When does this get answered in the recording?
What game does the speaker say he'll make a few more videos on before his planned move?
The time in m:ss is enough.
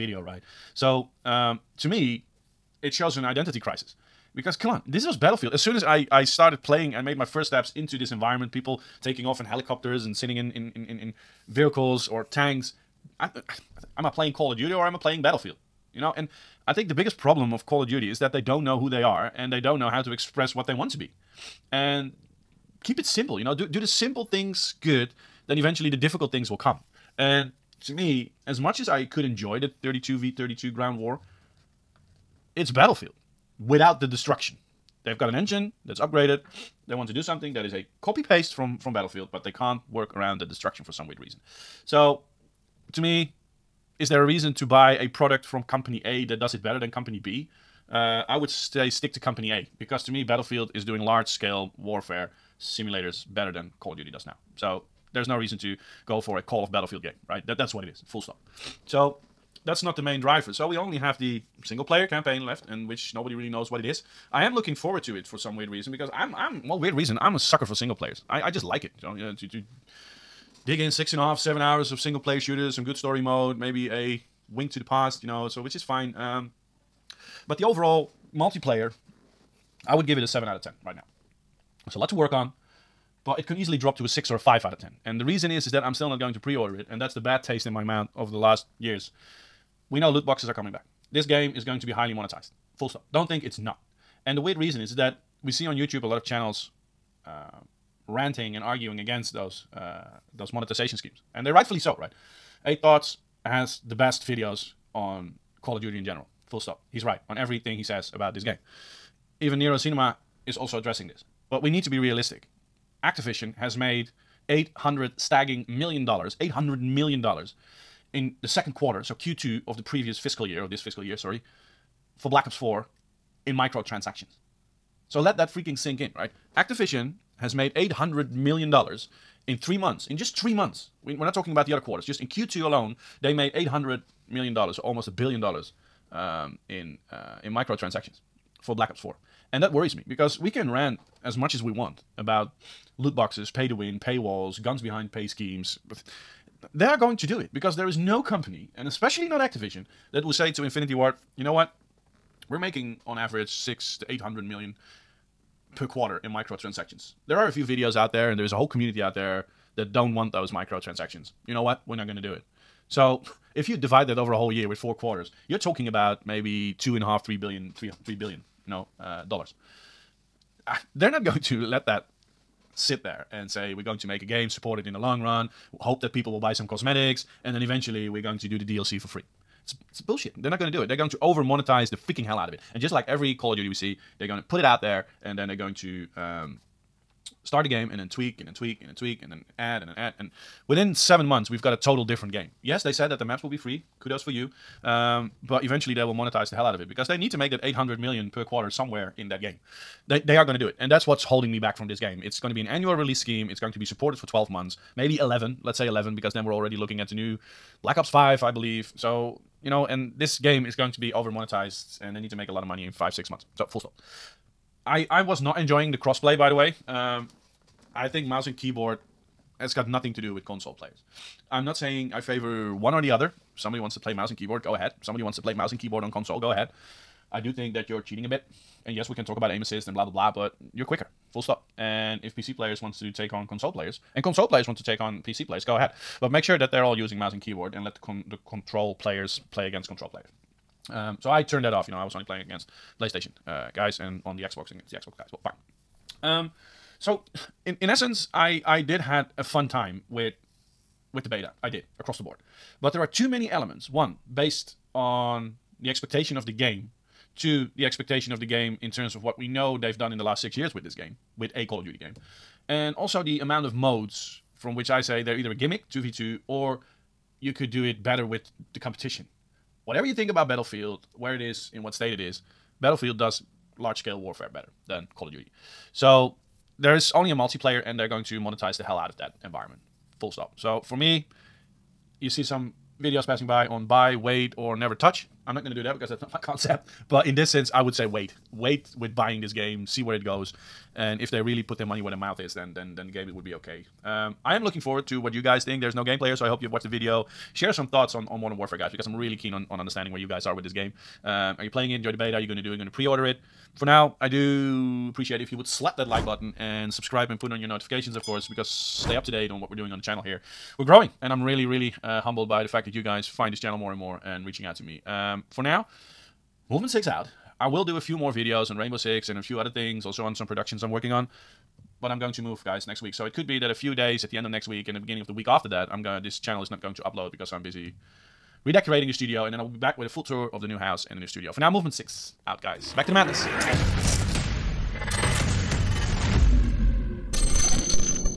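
5:18.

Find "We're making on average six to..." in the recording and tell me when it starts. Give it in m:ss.
2:32.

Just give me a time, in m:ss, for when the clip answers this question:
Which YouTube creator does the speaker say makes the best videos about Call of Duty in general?
1:42.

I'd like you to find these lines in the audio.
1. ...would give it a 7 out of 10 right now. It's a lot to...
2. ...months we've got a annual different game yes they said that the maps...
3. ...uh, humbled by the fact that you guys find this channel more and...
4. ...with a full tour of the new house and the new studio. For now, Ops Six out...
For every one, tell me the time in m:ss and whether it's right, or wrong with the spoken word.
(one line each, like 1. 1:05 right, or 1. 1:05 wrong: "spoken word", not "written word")
1. 1:19 right
2. 3:11 wrong: "total", not "annual"
3. 5:12 right
4. 5:29 wrong: "Movement", not "Ops".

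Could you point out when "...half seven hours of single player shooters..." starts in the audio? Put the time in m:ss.
1:11.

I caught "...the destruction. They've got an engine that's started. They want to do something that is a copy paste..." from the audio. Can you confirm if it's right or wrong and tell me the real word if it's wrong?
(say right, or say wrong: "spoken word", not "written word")
wrong: "upgraded", not "started".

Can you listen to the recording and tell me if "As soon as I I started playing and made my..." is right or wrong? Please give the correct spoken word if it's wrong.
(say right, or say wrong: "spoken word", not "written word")
right.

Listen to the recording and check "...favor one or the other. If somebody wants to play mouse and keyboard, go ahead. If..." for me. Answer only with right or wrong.
right.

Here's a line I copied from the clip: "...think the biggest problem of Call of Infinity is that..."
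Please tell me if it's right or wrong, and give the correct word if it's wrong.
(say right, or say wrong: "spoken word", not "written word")
wrong: "Duty", not "Infinity".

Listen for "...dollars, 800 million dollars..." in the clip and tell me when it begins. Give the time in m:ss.
1:56.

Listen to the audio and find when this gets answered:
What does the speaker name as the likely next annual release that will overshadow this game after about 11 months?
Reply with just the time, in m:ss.
3:27.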